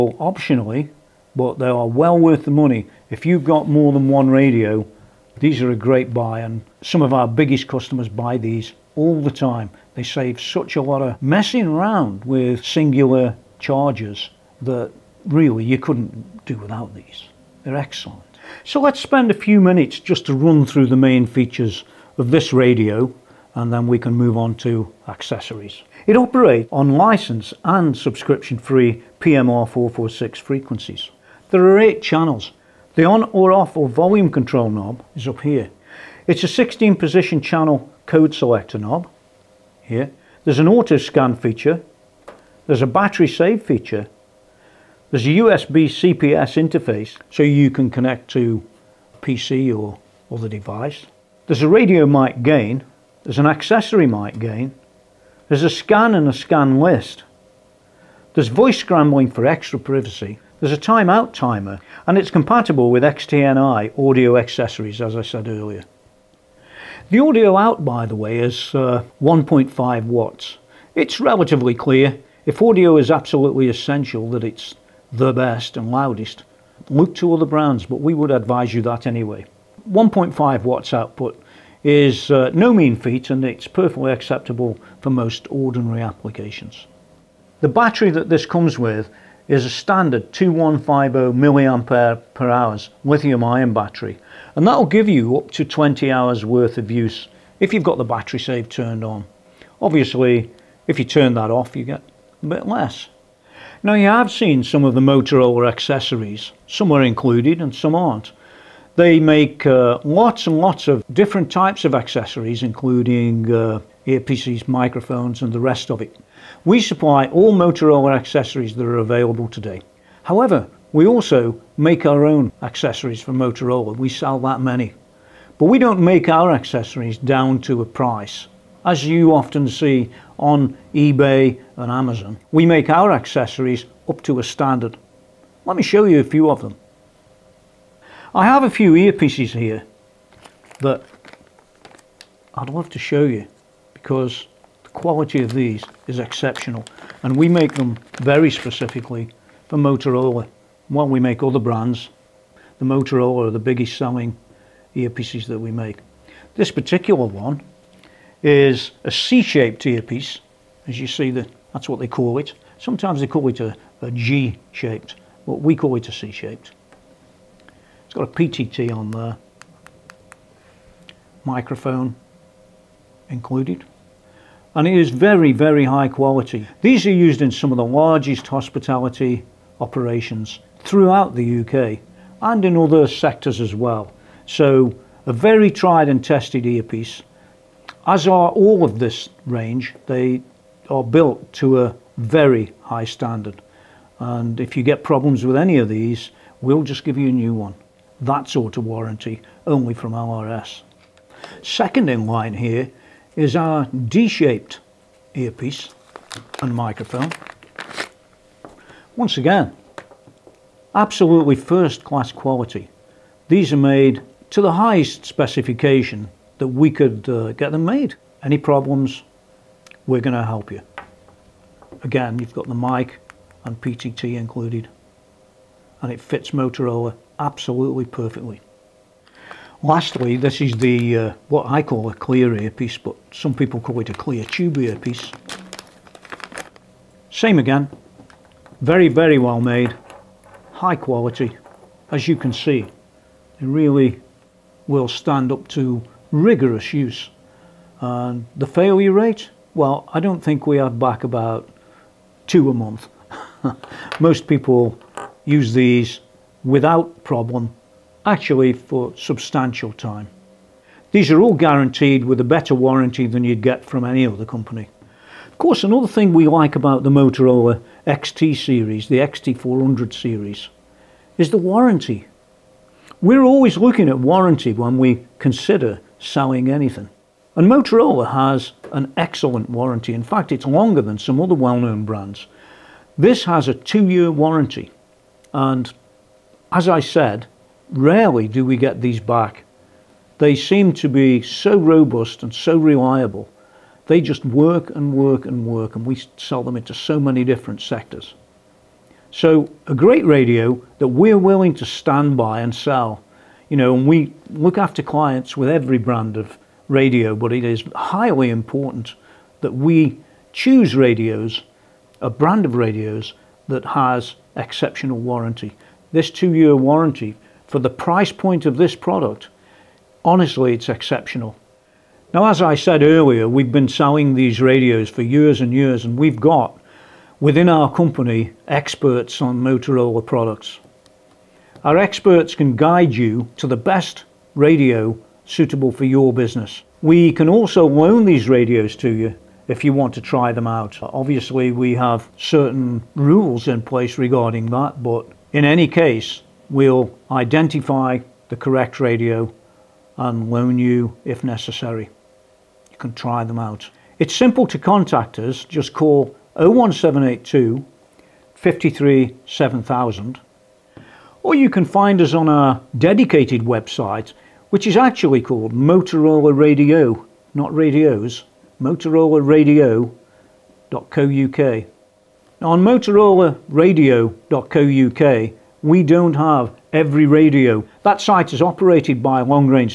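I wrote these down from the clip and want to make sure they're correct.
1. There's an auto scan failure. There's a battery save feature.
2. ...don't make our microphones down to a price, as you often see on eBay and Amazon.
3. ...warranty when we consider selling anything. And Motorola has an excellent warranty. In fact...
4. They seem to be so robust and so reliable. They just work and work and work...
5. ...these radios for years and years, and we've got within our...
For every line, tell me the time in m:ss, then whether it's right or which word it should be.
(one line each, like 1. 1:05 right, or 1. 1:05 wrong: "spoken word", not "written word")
1. 0:40 wrong: "feature", not "failure"
2. 2:05 wrong: "accessories", not "microphones"
3. 4:34 right
4. 4:50 right
5. 5:24 right.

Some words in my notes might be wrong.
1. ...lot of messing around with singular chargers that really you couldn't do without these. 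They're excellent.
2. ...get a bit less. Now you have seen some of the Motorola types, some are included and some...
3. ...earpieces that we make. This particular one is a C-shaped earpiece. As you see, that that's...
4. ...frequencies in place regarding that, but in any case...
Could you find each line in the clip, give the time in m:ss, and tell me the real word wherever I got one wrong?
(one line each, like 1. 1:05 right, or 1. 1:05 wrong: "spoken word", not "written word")
1. 0:10 right
2. 1:41 wrong: "accessories", not "types"
3. 2:34 right
4. 5:43 wrong: "rules", not "frequencies".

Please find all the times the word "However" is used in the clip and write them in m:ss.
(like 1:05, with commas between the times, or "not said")
2:00.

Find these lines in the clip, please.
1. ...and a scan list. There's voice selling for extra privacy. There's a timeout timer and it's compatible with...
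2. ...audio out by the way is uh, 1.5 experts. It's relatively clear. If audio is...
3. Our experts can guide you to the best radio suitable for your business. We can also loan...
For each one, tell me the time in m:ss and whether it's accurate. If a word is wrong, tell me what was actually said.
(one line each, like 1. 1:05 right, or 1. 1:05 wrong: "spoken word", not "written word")
1. 0:56 wrong: "scrambling", not "selling"
2. 1:07 wrong: "watts", not "experts"
3. 5:31 right.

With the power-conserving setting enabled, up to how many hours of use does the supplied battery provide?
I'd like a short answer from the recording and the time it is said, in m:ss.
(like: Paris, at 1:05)
20 hours, at 1:35.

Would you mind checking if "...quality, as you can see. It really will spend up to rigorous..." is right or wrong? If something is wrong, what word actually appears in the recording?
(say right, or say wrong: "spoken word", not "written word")
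wrong: "stand", not "spend".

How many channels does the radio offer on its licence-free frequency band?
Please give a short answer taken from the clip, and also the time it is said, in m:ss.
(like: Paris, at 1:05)
8, at 0:31.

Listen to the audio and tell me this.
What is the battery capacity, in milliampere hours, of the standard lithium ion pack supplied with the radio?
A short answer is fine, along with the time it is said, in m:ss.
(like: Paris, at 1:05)
2150, at 1:30.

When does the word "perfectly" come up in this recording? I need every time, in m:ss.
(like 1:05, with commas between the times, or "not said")
1:23, 3:48.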